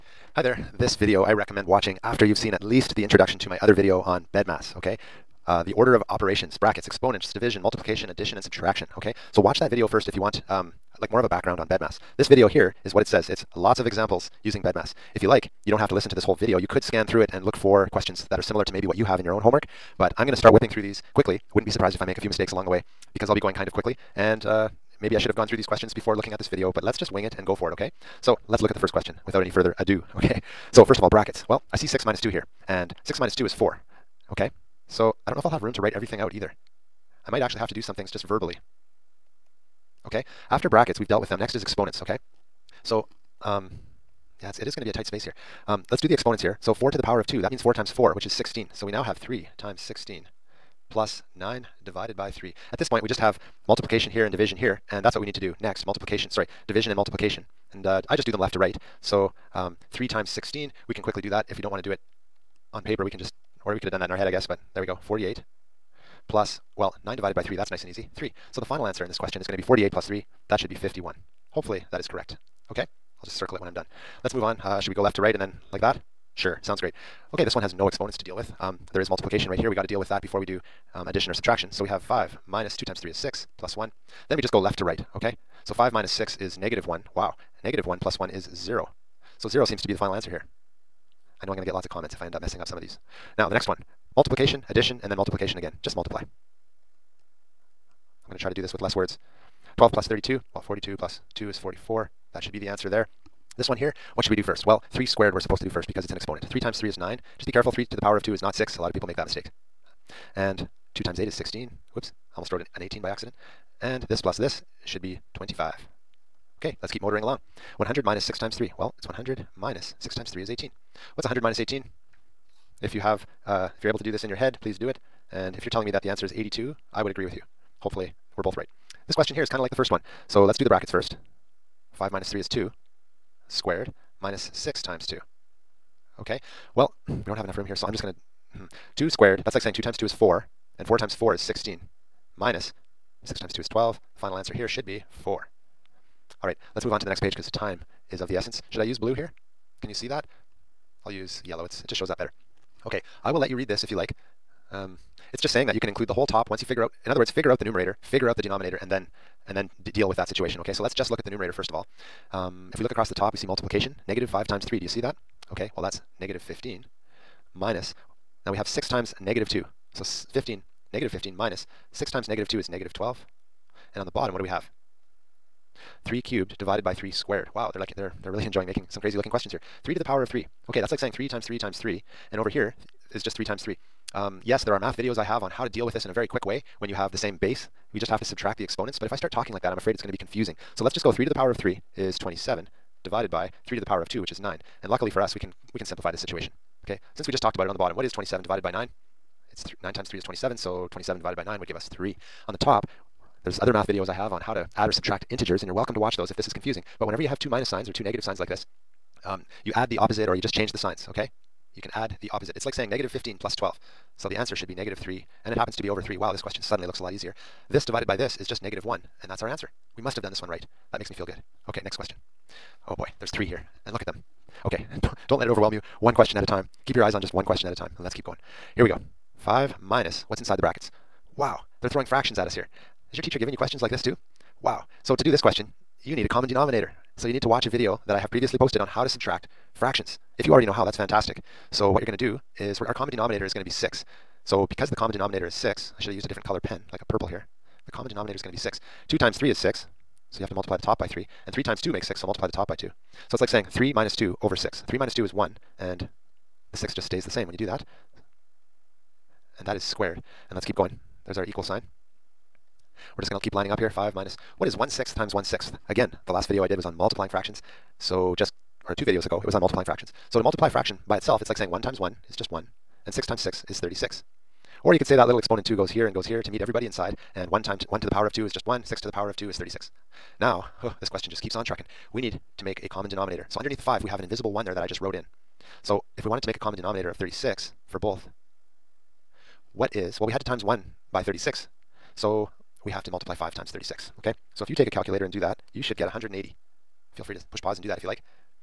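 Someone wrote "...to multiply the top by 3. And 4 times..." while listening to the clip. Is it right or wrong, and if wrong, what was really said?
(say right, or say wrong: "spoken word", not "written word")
wrong: "3", not "4".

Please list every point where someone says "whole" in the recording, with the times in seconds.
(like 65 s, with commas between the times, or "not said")
16 s, 156 s.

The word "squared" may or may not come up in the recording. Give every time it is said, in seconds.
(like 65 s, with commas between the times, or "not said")
105 s, 133 s, 139 s, 177 s, 259 s.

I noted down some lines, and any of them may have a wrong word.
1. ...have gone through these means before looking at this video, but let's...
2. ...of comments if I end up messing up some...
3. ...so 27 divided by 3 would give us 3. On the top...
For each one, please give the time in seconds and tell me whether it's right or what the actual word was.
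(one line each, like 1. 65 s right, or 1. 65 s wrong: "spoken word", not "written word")
1. 25 s wrong: "questions", not "means"
2. 91 s right
3. 200 s wrong: "9", not "3".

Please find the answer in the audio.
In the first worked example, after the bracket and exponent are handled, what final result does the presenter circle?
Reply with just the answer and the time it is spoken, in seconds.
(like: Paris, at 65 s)
51, at 70 s.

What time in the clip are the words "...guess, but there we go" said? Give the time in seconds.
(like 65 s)
64 s.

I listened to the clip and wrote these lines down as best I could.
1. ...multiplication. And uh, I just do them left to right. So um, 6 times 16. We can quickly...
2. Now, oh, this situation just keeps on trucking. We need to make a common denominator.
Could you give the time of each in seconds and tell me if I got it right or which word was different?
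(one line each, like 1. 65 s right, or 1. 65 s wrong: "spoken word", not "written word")
1. 56 s wrong: "3", not "6"
2. 280 s wrong: "question", not "situation".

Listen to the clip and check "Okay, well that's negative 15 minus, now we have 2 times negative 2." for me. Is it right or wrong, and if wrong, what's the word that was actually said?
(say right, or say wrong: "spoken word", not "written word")
wrong: "6", not "2".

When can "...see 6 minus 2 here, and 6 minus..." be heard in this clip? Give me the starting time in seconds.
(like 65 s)
31 s.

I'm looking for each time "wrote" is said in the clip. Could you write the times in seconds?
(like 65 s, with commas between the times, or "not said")
112 s, 285 s.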